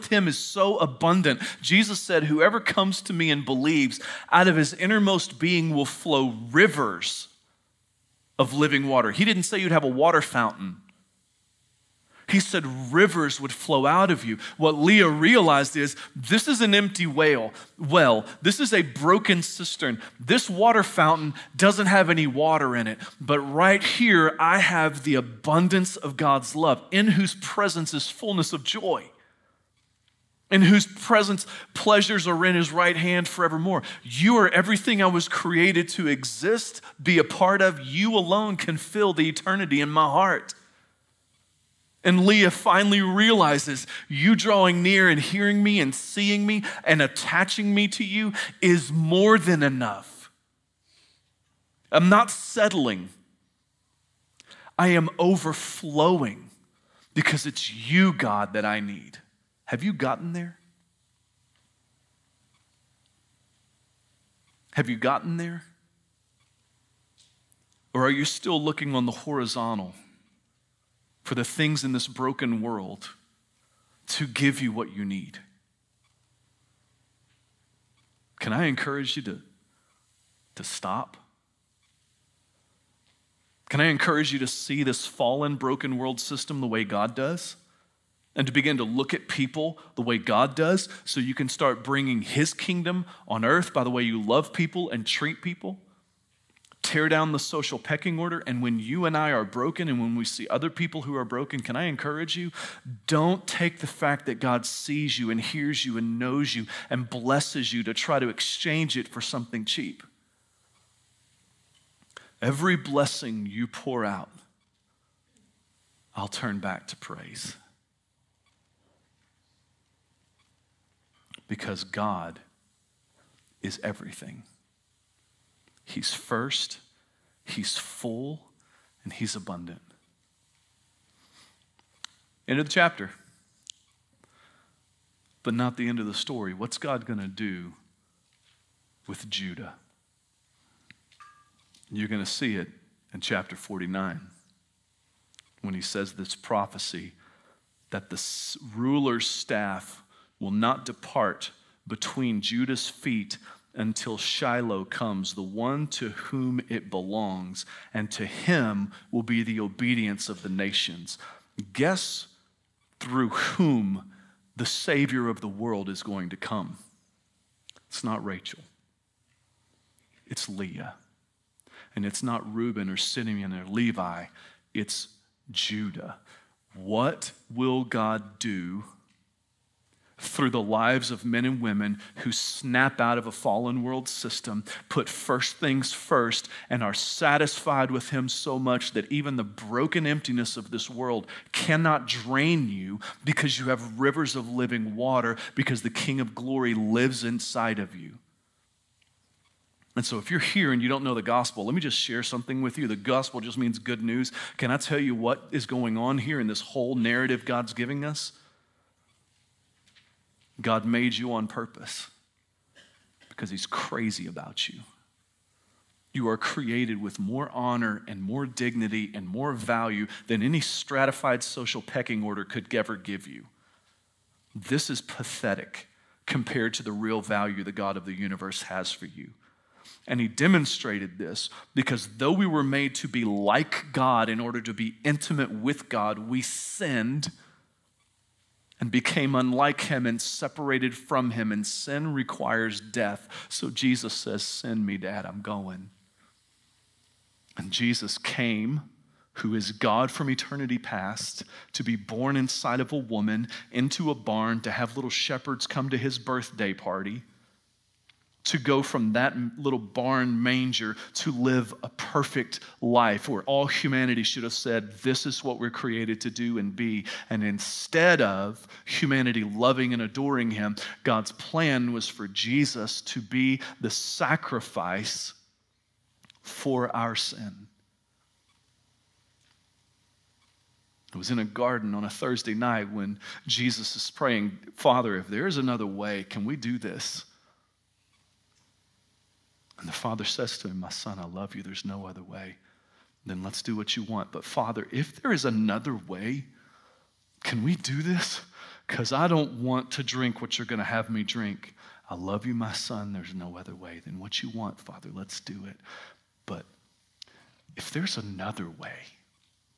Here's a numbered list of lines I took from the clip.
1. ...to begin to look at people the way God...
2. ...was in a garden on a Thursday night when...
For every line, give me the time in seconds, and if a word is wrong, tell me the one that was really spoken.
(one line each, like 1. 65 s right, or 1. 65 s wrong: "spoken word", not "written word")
1. 88 s right
2. 281 s right.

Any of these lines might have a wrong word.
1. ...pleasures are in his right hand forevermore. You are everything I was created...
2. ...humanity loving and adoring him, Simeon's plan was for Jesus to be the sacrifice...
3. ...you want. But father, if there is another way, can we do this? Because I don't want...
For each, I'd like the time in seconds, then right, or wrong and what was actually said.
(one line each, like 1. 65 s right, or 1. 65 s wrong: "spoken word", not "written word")
1. 31 s right
2. 268 s wrong: "God", not "Simeon"
3. 293 s right.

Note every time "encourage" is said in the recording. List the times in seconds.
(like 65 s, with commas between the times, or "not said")
78 s, 83 s, 101 s.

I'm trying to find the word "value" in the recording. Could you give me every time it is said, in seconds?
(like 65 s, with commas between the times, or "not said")
219 s, 227 s.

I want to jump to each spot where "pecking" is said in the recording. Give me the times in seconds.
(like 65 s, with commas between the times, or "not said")
97 s, 221 s.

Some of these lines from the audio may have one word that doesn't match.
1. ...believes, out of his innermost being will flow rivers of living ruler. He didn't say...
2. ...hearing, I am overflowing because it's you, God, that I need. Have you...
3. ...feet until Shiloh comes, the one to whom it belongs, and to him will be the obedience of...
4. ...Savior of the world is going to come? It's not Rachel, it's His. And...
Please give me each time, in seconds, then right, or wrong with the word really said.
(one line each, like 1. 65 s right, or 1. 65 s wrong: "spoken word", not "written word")
1. 3 s wrong: "water", not "ruler"
2. 52 s wrong: "settling", not "hearing"
3. 152 s right
4. 164 s wrong: "Leah", not "His".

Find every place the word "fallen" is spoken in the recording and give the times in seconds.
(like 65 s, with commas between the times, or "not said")
85 s, 183 s.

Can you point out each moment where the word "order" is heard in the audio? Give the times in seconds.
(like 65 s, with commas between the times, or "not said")
98 s, 222 s, 234 s.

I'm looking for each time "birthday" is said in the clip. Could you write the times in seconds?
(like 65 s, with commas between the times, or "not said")
256 s.